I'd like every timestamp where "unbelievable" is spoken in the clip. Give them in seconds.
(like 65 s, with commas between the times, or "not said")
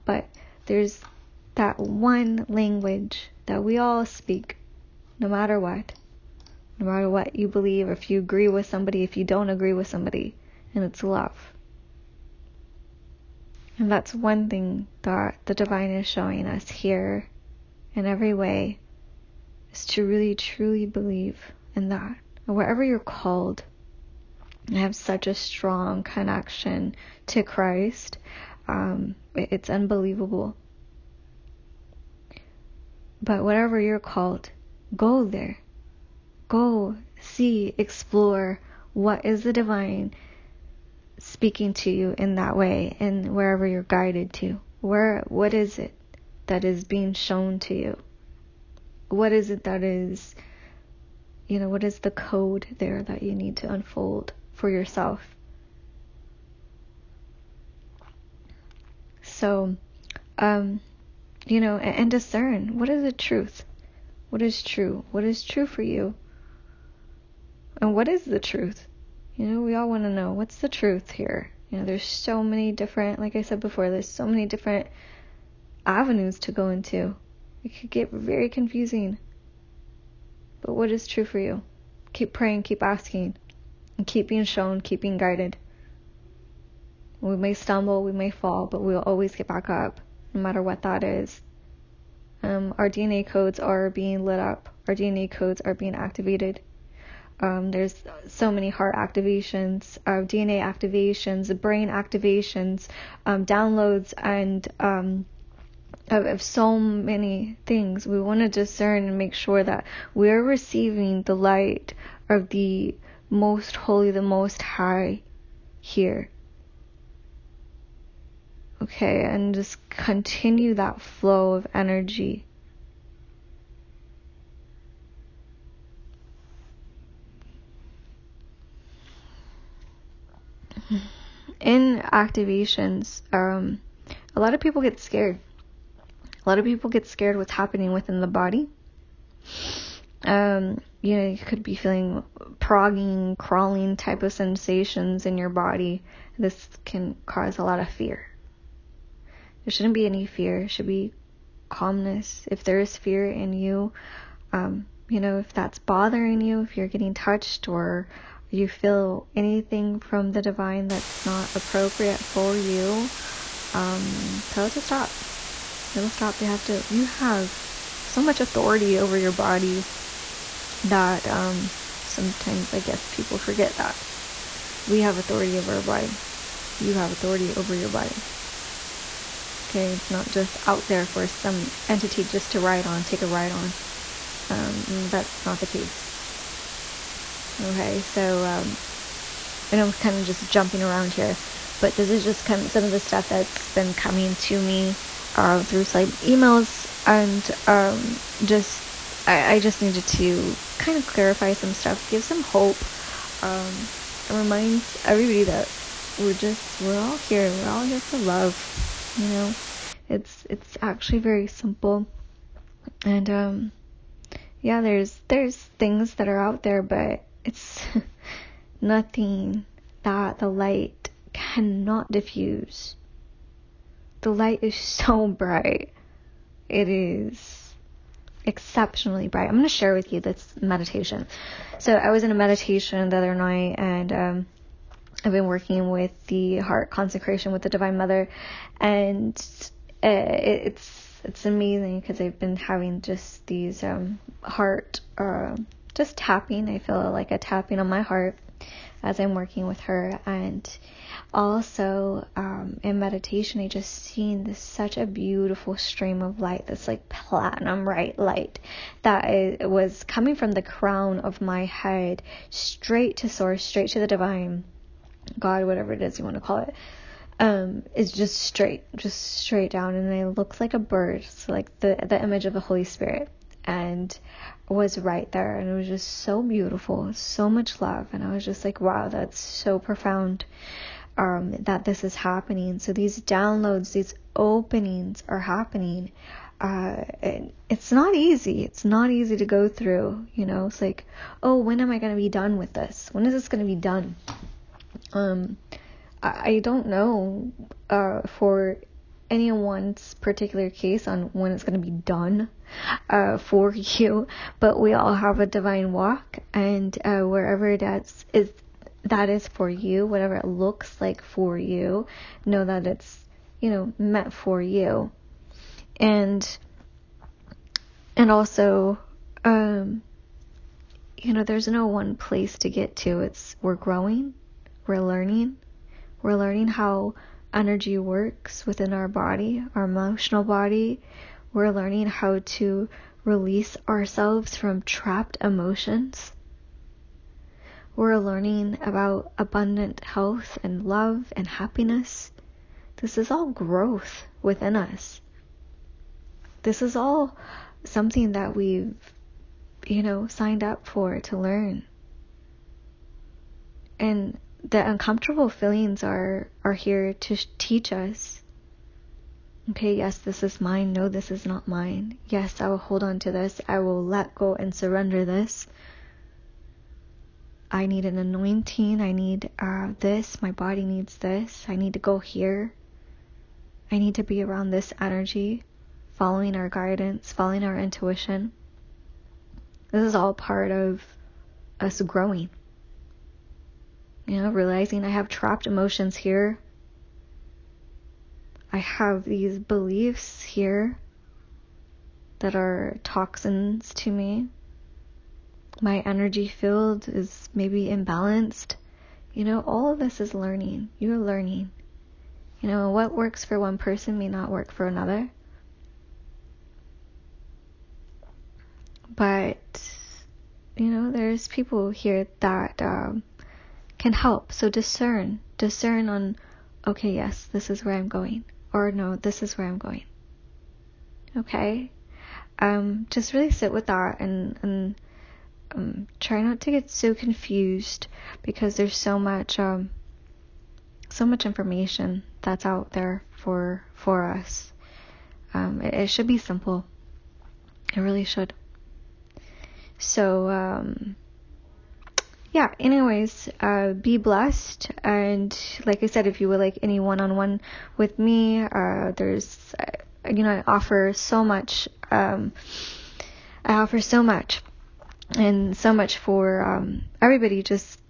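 29 s.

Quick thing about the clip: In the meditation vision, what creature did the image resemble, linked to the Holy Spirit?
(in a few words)
a bird.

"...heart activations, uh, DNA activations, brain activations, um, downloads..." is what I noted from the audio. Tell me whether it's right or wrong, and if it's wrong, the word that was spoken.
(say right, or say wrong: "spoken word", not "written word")
right.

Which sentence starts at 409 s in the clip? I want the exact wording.
But, you know, there's people here that um, can help.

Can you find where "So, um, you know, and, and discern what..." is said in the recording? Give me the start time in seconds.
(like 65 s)
59 s.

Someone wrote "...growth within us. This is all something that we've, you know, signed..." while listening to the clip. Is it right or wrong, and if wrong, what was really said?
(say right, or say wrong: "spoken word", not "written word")
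right.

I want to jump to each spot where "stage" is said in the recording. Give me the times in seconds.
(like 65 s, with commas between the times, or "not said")
not said.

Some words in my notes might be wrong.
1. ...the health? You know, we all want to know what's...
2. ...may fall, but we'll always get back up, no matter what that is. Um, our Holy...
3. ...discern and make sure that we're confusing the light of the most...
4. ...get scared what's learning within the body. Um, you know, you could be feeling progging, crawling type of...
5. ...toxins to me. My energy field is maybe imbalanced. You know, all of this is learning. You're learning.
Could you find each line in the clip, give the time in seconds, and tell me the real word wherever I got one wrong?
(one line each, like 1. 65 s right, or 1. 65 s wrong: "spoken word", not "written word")
1. 68 s wrong: "truth", not "health"
2. 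88 s wrong: "DNA", not "Holy"
3. 108 s wrong: "receiving", not "confusing"
4. 136 s wrong: "happening", not "learning"
5. 393 s right.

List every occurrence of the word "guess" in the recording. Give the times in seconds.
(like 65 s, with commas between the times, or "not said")
172 s.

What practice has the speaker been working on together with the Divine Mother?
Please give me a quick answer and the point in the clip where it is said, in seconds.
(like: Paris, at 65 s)
heart consecration, at 236 s.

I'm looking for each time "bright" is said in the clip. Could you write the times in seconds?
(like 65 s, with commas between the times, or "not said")
225 s, 229 s, 257 s.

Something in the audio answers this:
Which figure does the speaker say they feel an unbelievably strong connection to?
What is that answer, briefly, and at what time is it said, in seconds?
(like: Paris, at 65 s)
Christ, at 27 s.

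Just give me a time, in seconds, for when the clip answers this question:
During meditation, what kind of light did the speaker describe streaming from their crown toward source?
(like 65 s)
257 s.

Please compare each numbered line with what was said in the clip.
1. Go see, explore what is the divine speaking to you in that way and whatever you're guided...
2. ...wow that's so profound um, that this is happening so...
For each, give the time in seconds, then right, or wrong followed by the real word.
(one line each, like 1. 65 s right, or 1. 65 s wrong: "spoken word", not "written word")
1. 36 s wrong: "wherever", not "whatever"
2. 278 s right.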